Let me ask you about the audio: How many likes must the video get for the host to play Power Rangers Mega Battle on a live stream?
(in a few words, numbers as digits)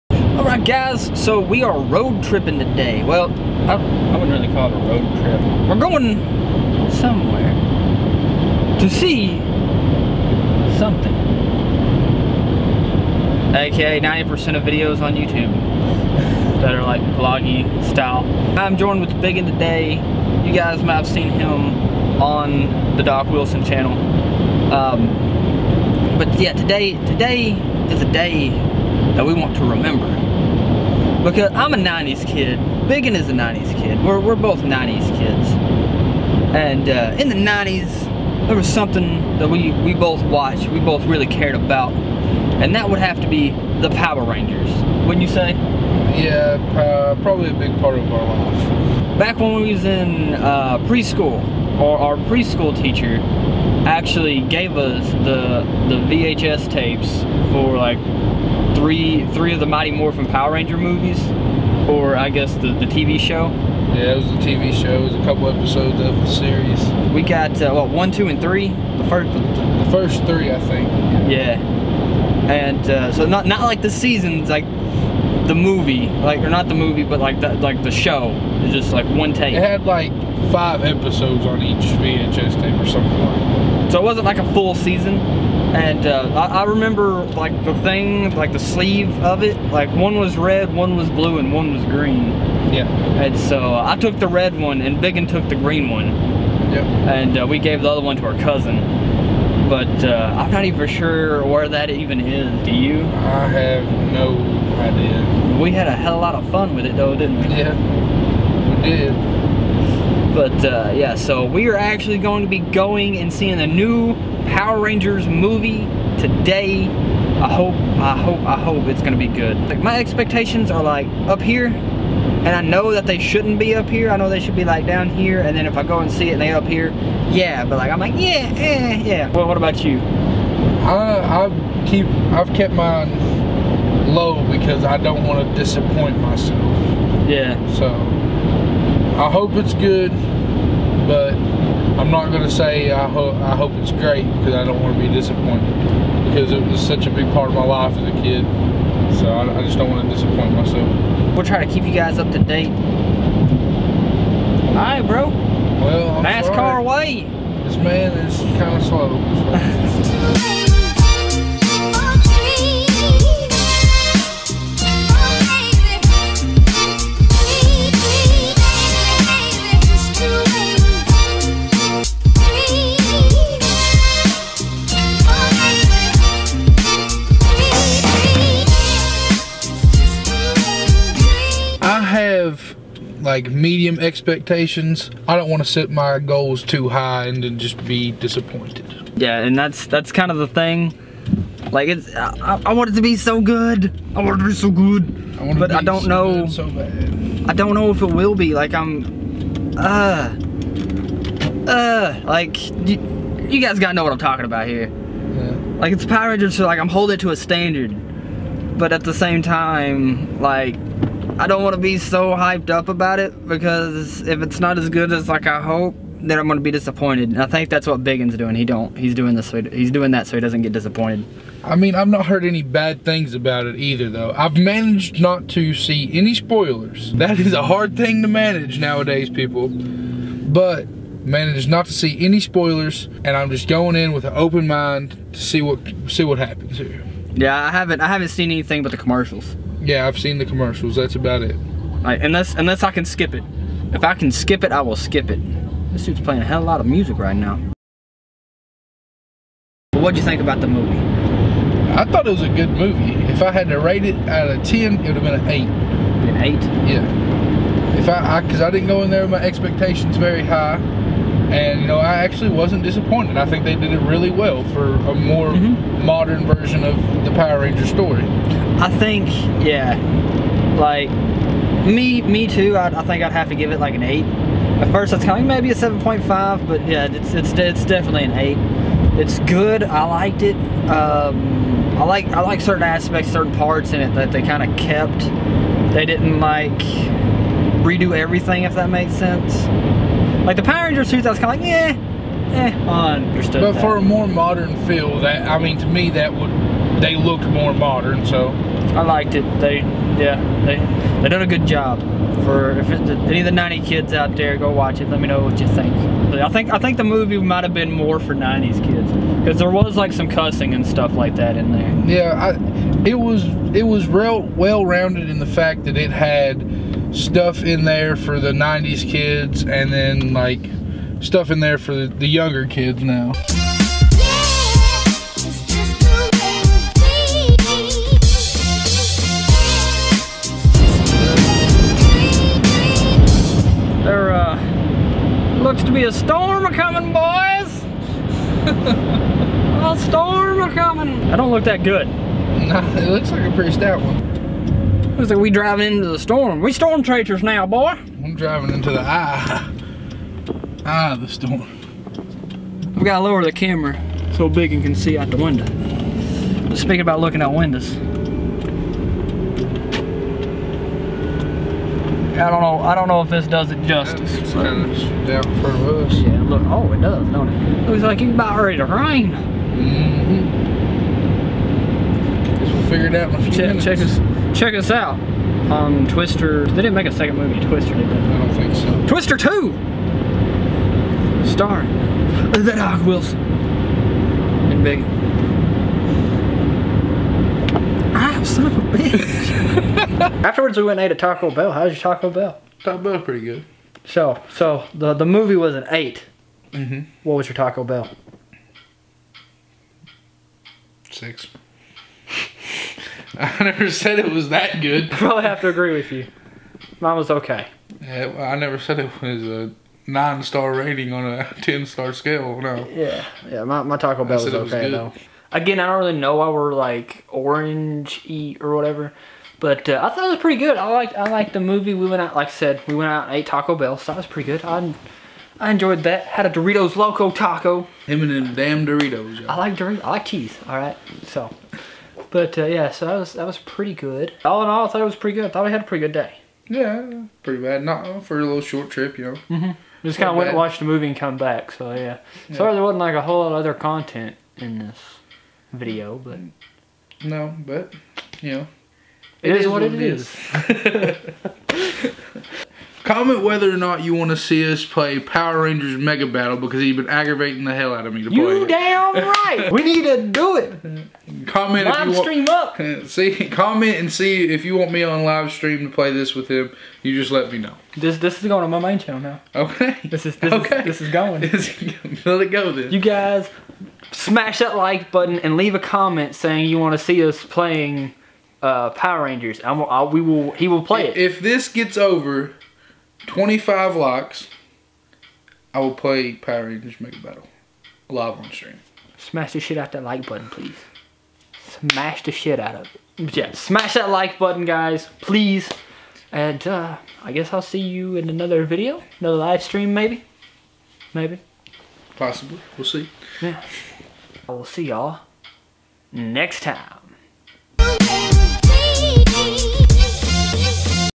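25.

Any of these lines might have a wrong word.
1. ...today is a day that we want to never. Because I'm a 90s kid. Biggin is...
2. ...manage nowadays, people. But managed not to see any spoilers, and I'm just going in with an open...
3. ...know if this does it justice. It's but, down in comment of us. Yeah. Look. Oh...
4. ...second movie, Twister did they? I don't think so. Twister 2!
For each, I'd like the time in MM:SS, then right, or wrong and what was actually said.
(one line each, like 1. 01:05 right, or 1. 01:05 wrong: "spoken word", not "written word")
1. 00:27 wrong: "remember", not "never"
2. 03:48 right
3. 06:03 wrong: "front", not "comment"
4. 06:17 right.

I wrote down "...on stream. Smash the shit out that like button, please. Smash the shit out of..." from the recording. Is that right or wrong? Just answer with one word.
right.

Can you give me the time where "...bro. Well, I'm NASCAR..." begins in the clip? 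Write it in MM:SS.
02:35.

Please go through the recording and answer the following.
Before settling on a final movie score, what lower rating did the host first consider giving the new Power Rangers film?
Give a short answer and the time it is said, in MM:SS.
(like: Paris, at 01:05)
7.5, at 04:35.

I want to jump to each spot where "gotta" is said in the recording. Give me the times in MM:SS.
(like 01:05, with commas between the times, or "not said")
03:23, 05:53.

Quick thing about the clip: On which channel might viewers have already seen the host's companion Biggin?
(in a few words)
Doc Wilson channel.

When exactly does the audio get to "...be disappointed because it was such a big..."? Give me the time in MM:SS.
02:25.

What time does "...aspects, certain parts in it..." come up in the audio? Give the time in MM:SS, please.
04:42.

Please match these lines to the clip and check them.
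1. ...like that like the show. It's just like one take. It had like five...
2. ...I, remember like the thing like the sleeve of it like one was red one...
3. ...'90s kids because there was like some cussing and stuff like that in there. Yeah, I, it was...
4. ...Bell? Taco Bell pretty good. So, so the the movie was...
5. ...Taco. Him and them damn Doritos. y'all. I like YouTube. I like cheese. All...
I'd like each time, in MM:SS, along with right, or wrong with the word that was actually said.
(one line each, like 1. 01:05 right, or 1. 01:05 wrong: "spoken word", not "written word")
1. 01:17 right
2. 01:26 right
3. 05:08 right
4. 06:32 right
5. 07:07 wrong: "Doritos", not "YouTube".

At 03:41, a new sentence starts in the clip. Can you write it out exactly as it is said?
I mean, I've not heard any bad things about it either, though.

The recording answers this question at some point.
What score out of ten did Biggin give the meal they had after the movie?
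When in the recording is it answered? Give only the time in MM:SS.
06:41.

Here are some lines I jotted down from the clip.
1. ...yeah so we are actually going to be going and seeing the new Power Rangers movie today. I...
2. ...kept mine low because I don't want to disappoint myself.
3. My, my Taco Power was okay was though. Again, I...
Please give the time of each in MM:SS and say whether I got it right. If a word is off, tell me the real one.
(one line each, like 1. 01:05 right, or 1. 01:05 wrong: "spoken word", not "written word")
1. 01:50 right
2. 02:12 right
3. 06:53 wrong: "Bell", not "Power".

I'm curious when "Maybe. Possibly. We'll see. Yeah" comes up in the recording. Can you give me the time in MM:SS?
08:21.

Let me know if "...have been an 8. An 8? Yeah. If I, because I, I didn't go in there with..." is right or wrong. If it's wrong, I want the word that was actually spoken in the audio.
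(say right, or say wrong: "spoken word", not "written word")
right.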